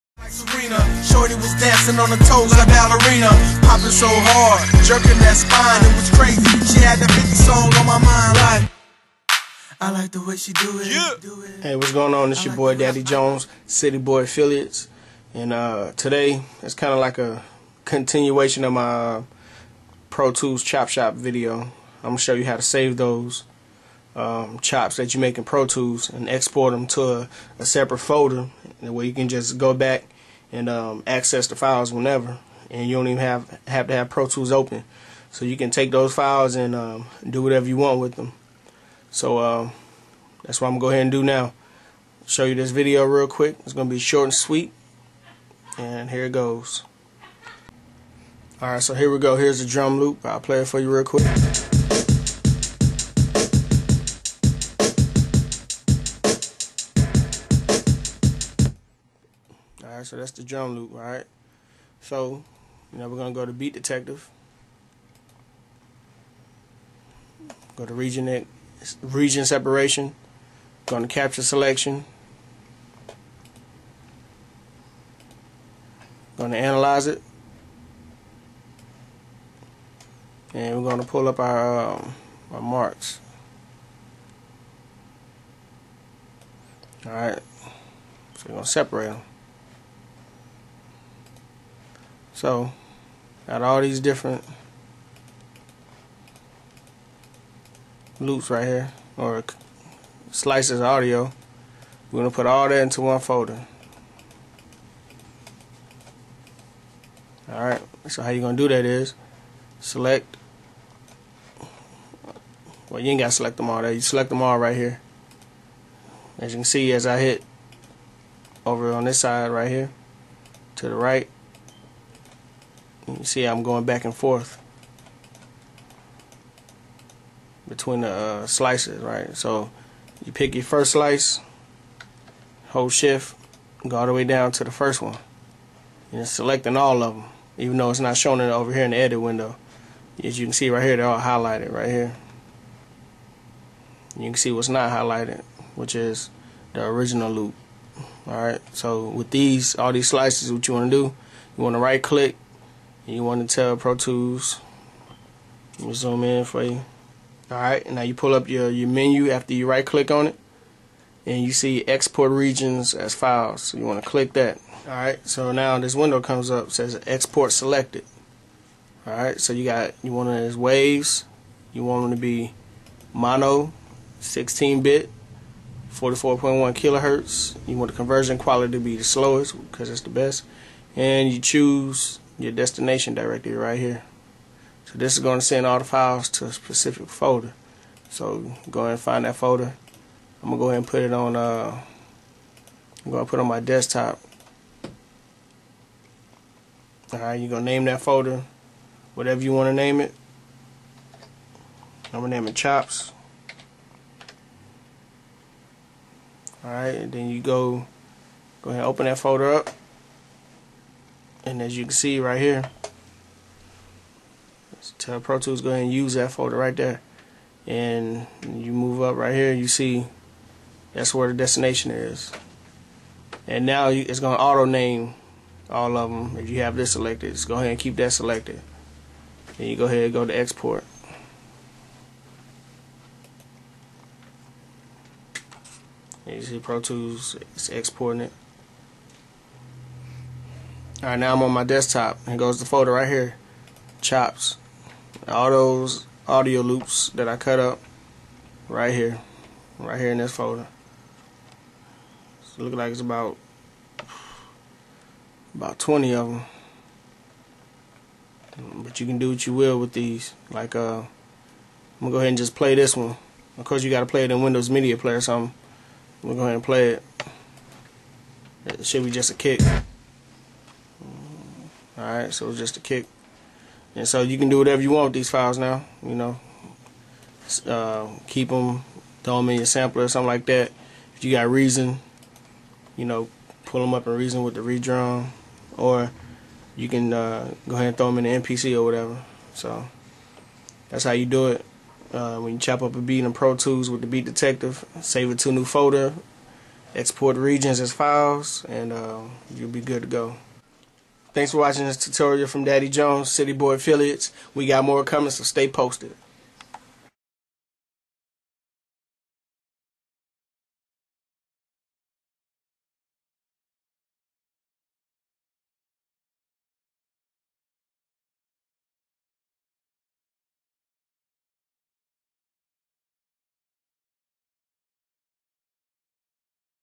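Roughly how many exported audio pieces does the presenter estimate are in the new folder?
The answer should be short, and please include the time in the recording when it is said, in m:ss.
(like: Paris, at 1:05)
20, at 4:15.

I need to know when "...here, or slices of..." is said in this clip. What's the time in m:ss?
1:38.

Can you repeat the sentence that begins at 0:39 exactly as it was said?
So um, that's what I'm gonna go ahead and do now.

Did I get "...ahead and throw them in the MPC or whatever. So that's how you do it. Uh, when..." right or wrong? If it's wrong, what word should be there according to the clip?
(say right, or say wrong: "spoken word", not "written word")
right.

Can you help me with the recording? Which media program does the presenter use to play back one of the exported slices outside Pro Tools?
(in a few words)
Windows Media Player.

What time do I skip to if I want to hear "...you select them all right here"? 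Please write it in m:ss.
1:53.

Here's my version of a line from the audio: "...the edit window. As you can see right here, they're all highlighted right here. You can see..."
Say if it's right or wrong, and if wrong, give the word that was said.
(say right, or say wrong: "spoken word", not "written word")
right.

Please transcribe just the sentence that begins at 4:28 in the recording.
It should be just a kick.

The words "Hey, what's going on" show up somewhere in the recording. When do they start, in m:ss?
0:11.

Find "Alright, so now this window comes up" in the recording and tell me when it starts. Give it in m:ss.
2:44.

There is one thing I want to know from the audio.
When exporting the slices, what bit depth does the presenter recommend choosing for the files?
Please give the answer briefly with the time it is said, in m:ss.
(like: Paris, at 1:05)
16 bit, at 2:54.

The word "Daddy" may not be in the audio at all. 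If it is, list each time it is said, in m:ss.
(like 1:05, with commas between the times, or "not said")
0:12, 5:02.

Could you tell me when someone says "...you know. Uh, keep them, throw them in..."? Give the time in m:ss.
4:36.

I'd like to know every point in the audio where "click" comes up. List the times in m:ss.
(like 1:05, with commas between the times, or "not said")
2:32, 2:39, 2:44.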